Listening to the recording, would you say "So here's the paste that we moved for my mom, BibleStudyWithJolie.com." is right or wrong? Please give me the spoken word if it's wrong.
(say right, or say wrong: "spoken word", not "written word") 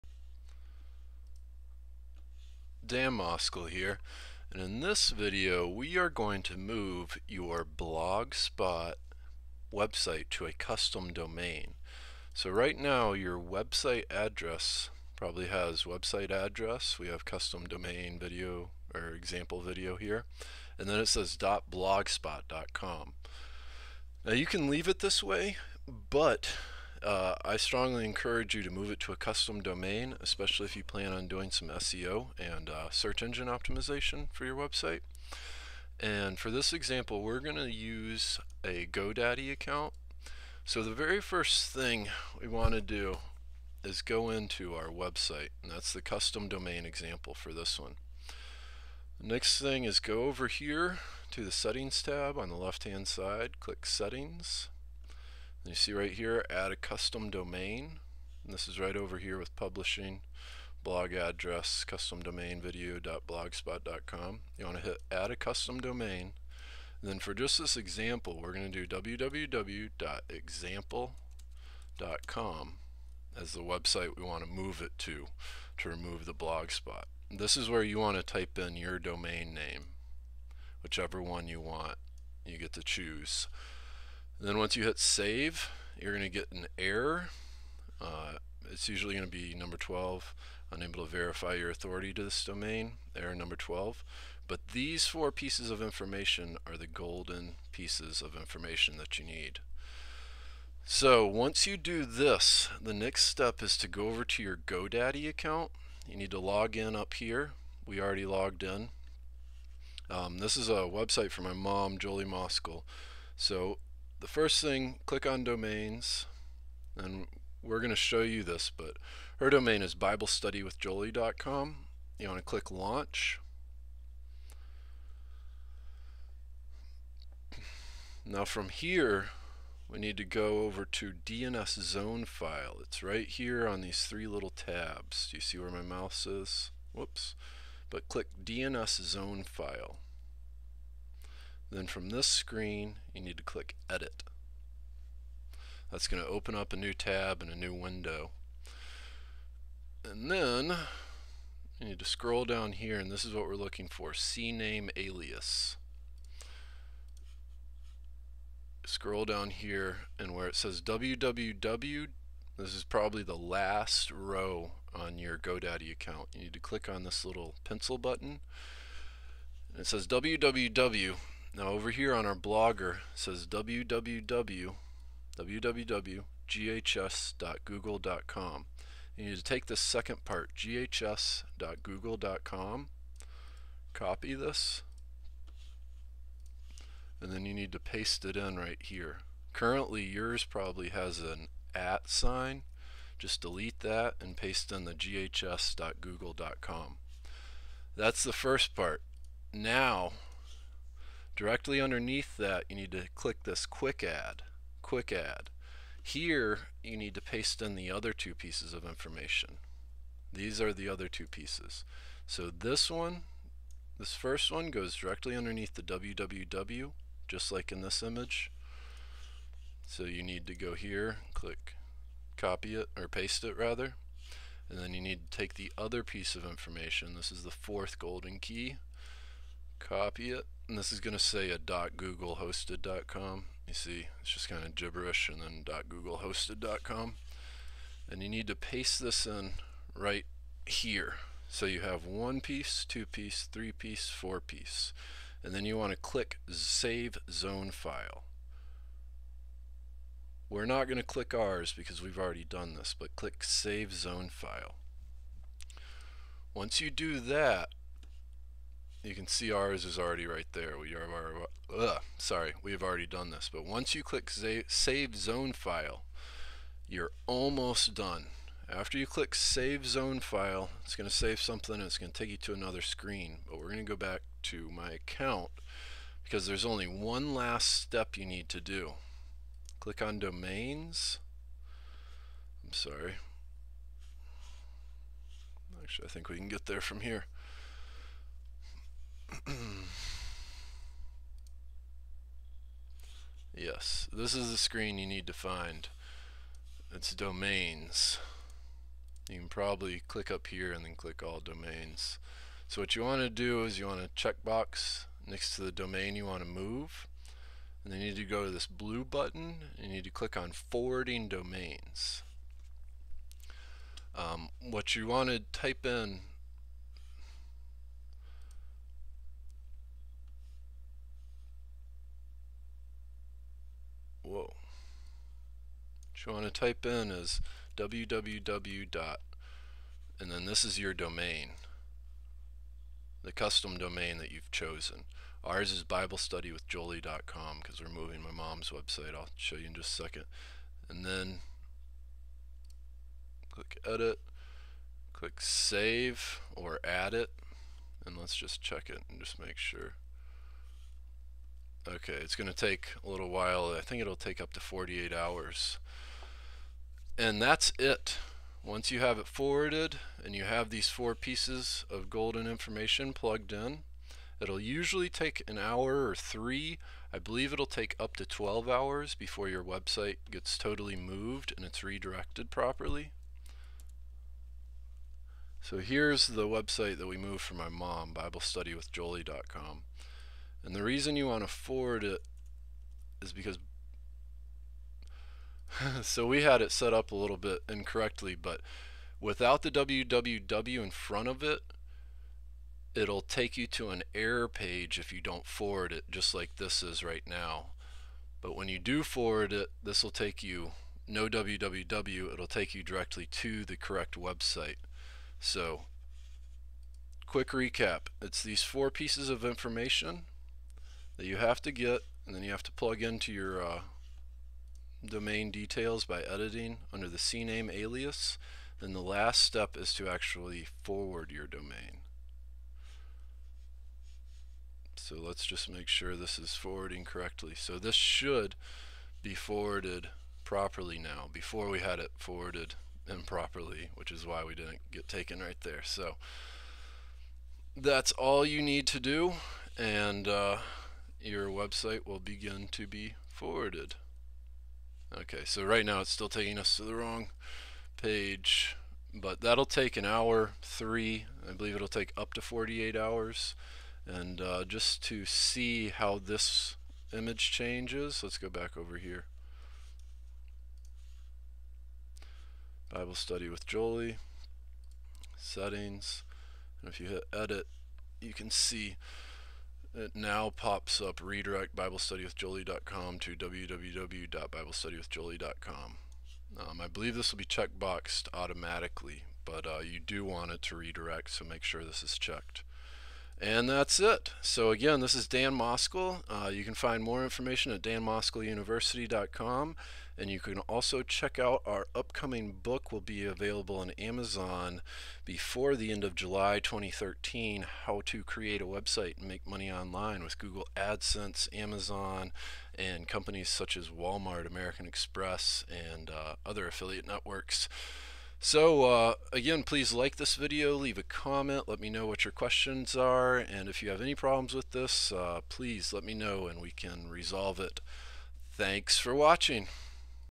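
wrong: "website", not "paste".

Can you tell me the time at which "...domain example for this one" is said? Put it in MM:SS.
00:46.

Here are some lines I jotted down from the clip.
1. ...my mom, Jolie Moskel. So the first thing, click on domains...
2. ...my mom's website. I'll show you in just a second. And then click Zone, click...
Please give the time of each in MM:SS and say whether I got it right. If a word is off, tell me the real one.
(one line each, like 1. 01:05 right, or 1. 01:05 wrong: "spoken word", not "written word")
1. 01:51 right
2. 05:38 wrong: "Edit", not "Zone".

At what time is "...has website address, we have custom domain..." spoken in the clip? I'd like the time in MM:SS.
00:15.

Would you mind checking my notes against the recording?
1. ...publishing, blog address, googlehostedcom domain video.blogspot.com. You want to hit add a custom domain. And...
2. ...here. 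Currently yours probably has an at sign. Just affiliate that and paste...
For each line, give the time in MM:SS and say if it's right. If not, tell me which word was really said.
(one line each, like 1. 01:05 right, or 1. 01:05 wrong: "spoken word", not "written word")
1. 00:59 wrong: "custom", not "googlehostedcom"
2. 03:08 wrong: "delete", not "affiliate".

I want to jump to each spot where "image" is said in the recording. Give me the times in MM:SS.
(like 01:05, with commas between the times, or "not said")
03:38, 07:37.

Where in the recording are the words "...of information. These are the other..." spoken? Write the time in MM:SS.
03:28.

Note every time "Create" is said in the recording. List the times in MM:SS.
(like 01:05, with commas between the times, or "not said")
08:18.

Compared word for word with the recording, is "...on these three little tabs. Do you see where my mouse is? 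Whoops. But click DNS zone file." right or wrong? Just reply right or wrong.
right.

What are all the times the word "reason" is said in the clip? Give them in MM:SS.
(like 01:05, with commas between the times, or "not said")
06:20.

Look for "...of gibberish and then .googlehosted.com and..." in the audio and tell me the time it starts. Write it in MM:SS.
03:54.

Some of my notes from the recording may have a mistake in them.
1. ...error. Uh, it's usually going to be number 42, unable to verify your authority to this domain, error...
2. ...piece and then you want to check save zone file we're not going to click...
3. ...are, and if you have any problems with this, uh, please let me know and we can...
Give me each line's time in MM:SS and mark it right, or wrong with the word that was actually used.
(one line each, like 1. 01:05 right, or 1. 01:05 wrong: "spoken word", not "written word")
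1. 01:26 wrong: "12", not "42"
2. 04:04 wrong: "click", not "check"
3. 08:32 right.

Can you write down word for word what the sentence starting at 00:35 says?
And for this example, we're going to use a GoDaddy account.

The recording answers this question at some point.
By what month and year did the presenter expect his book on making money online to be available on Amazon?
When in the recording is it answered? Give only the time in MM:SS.
08:16.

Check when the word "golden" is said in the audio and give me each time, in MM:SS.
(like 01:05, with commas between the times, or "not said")
01:36, 03:47, 06:02.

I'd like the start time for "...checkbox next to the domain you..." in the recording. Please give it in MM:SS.
05:04.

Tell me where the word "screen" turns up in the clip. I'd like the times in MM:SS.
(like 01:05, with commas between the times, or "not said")
02:22, 04:32, 04:54.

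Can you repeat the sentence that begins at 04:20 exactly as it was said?
We are, ugh, sorry, we have already done this.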